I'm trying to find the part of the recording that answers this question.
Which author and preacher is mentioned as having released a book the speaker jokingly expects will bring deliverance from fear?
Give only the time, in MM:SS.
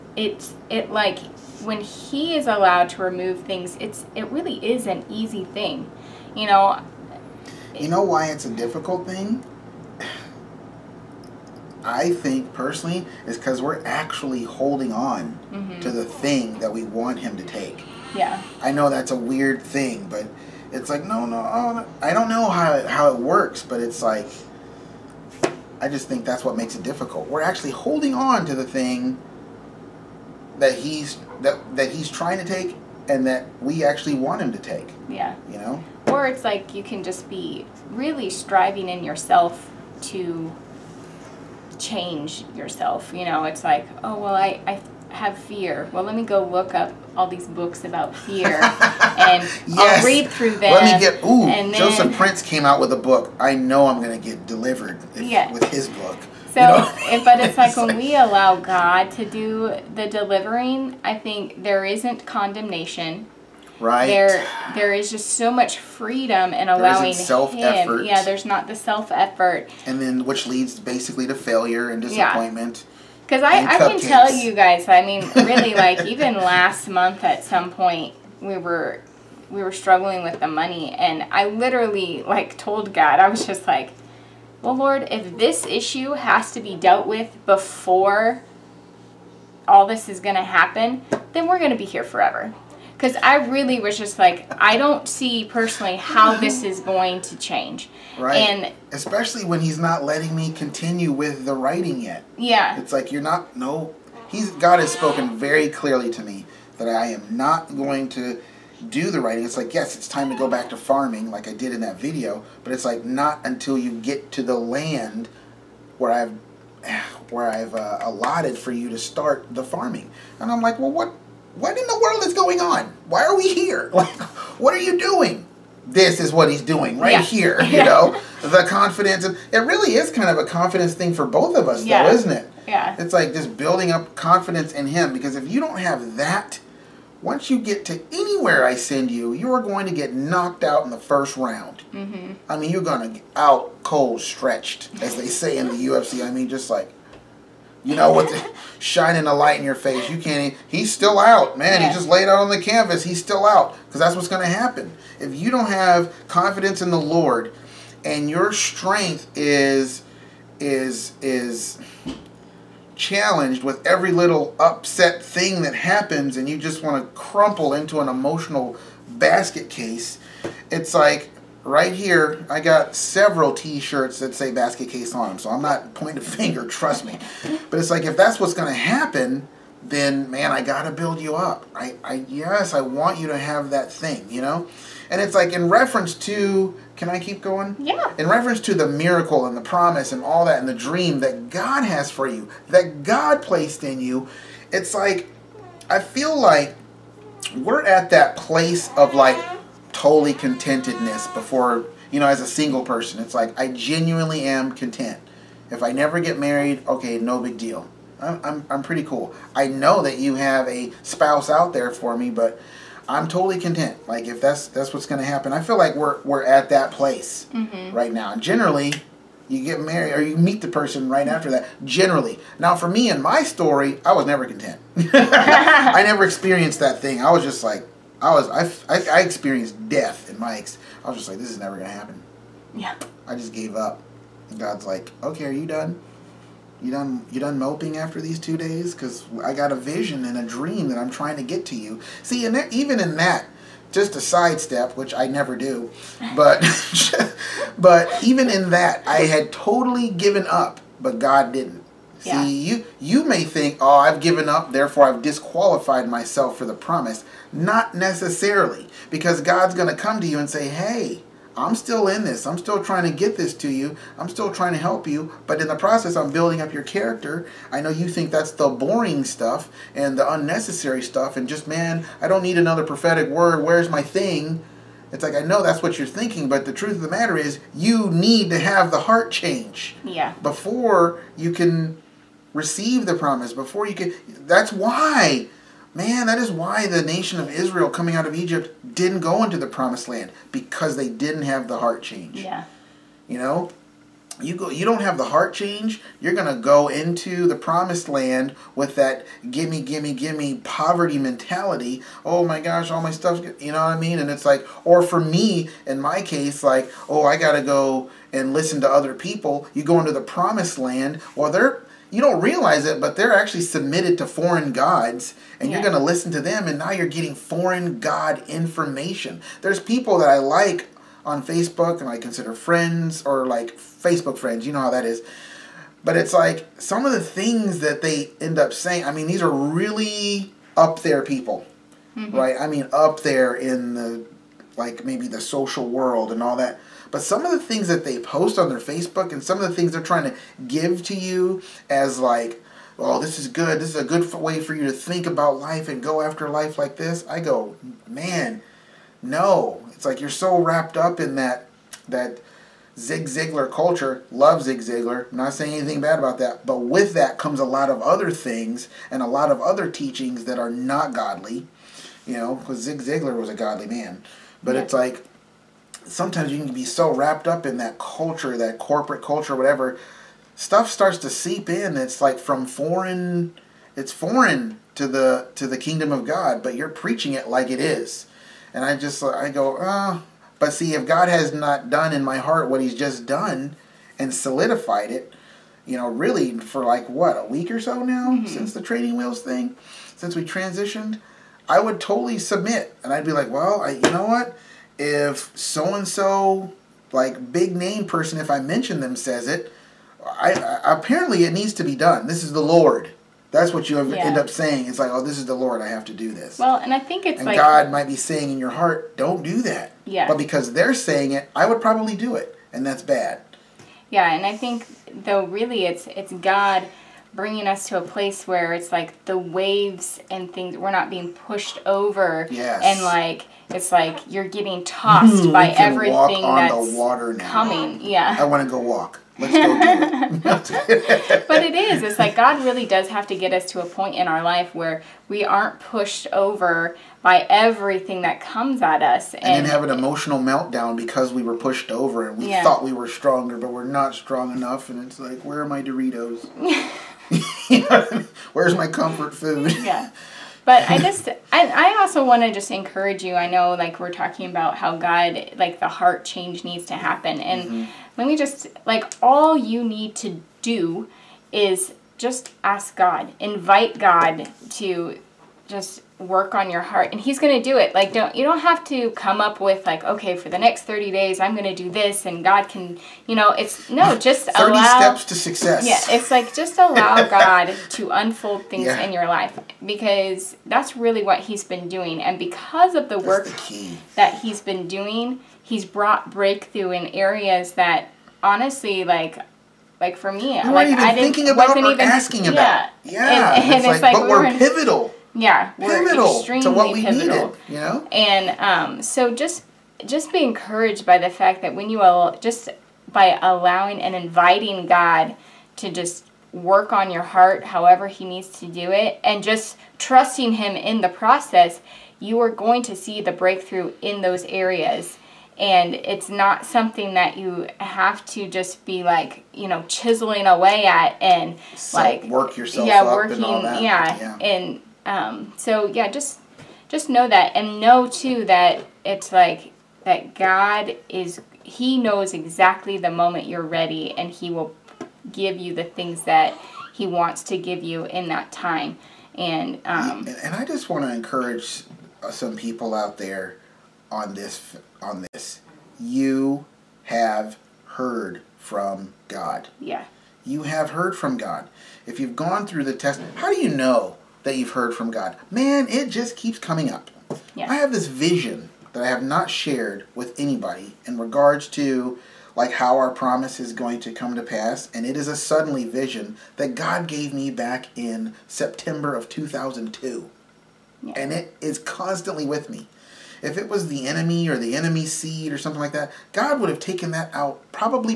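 00:51.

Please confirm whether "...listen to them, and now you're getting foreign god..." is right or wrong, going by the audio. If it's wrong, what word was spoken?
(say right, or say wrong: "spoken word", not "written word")
right.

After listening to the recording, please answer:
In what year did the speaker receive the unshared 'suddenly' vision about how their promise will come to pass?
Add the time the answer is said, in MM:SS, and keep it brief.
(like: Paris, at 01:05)
2002, at 09:29.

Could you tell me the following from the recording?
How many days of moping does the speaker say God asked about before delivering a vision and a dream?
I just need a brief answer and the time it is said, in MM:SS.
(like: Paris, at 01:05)
2, at 03:58.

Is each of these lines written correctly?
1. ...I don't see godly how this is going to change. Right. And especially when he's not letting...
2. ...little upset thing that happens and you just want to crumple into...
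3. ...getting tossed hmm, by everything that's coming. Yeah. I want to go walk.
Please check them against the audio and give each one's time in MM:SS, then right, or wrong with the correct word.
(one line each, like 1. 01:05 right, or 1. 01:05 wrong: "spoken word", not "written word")
1. 01:34 wrong: "personally", not "godly"
2. 02:44 right
3. 07:04 right.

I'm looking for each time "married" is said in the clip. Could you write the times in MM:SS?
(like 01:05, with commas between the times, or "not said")
03:26, 03:39.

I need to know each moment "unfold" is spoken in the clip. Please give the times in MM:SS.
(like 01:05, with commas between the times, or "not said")
07:58.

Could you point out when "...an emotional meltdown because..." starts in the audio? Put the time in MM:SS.
07:19.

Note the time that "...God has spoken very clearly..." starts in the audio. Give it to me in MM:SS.
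01:44.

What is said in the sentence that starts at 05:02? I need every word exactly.
Oh my gosh, all my stuff, you know what I mean?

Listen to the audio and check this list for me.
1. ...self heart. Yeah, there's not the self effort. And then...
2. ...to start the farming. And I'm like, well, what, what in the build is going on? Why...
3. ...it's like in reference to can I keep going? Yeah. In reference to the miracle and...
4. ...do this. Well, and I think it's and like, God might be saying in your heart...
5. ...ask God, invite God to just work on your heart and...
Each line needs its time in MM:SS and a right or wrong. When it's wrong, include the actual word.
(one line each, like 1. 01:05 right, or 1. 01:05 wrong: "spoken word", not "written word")
1. 01:07 wrong: "effort", not "heart"
2. 01:58 wrong: "world", not "build"
3. 03:05 right
4. 06:46 right
5. 07:42 right.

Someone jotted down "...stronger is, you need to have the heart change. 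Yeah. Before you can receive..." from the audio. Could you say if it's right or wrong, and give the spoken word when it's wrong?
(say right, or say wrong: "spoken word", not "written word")
wrong: "matter", not "stronger".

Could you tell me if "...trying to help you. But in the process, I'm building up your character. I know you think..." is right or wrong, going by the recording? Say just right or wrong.
right.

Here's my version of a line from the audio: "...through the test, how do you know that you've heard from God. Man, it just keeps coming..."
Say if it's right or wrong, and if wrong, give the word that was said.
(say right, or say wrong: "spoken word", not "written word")
right.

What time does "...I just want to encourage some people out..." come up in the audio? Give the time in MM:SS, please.
09:00.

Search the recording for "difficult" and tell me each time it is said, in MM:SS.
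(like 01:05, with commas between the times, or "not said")
00:08, 00:26.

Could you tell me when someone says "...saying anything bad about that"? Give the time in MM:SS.
05:55.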